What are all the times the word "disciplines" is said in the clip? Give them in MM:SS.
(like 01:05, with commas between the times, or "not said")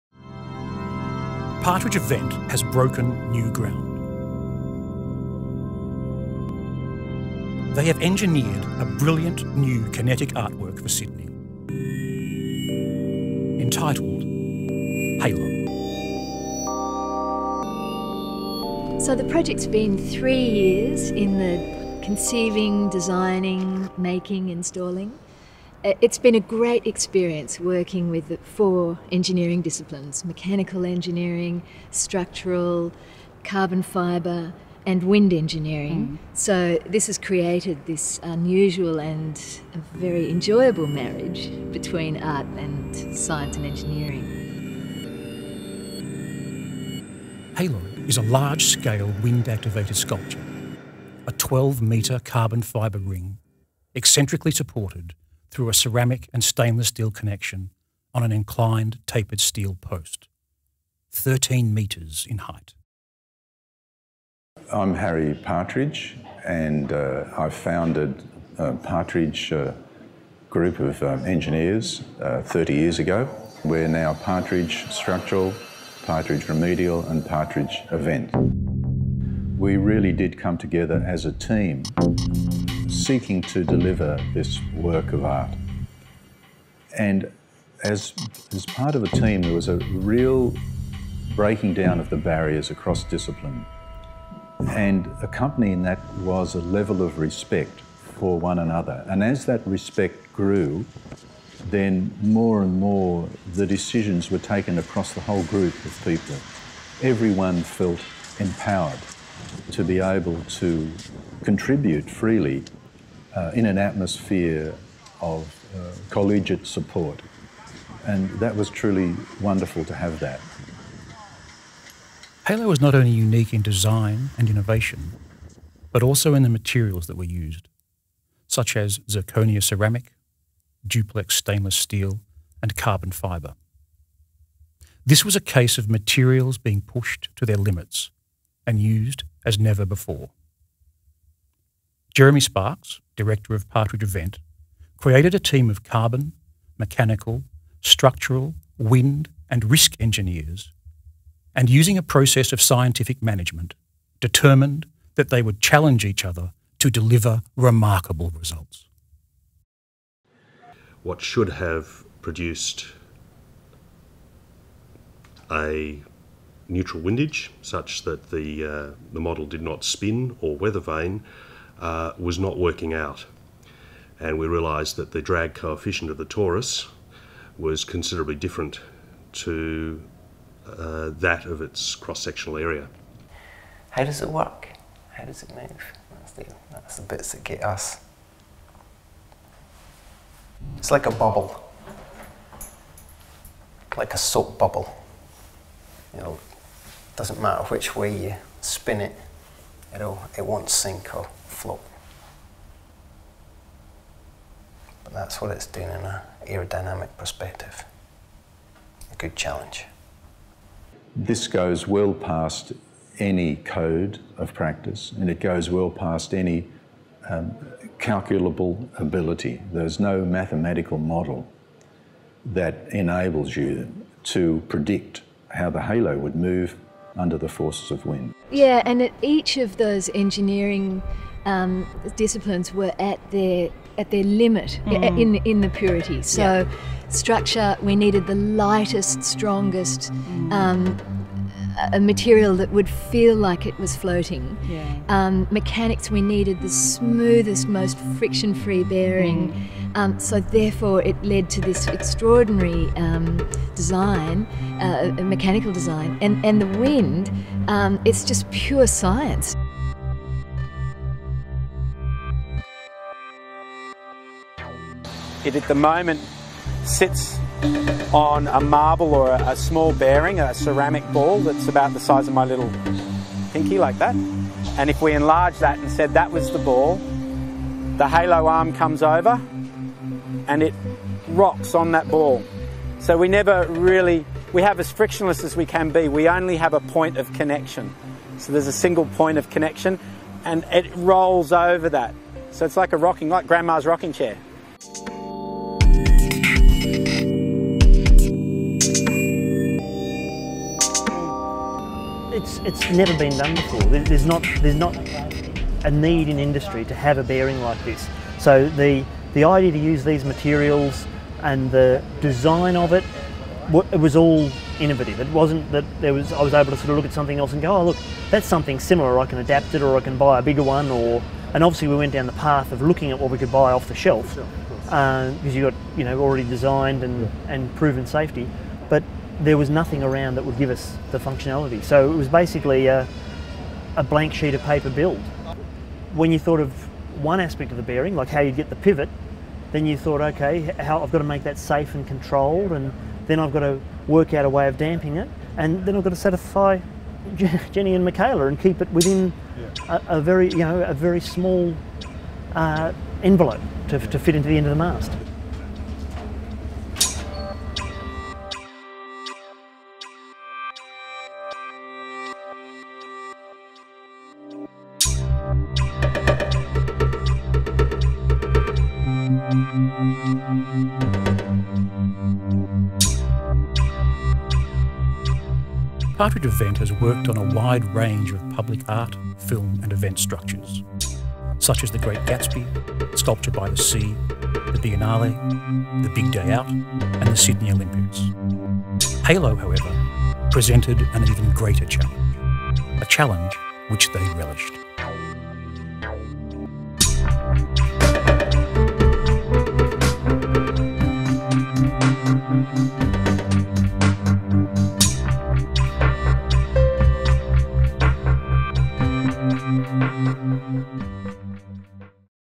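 00:29, 01:33, 03:52.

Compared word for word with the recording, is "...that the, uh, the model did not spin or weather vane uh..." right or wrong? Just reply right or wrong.
right.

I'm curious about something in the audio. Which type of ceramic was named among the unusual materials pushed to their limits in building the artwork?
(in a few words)
zirconia ceramic.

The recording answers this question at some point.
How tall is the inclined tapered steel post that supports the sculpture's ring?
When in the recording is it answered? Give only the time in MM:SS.
01:01.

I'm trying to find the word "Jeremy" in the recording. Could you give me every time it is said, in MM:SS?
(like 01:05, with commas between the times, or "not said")
02:22.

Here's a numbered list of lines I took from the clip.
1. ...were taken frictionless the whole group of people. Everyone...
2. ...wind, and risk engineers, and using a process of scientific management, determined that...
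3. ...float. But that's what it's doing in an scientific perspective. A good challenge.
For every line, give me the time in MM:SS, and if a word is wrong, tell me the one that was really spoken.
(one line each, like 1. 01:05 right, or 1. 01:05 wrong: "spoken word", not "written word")
1. 01:44 wrong: "across", not "frictionless"
2. 02:28 right
3. 03:21 wrong: "aerodynamic", not "scientific".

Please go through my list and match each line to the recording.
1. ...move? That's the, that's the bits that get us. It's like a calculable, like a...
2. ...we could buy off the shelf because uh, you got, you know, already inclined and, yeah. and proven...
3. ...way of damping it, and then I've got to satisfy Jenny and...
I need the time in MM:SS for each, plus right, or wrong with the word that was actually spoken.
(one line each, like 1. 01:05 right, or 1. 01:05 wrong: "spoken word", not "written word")
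1. 03:05 wrong: "bubble", not "calculable"
2. 05:23 wrong: "designed", not "inclined"
3. 05:44 right.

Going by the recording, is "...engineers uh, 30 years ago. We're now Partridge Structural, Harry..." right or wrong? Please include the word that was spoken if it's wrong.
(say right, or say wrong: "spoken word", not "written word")
wrong: "Partridge", not "Harry".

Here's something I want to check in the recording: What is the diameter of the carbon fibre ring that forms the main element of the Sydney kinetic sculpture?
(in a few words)
12 metres.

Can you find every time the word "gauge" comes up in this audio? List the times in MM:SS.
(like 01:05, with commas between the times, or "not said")
not said.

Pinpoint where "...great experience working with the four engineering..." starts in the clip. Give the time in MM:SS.
00:26.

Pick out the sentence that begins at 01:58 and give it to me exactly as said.
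And that was truly wonderful to have that.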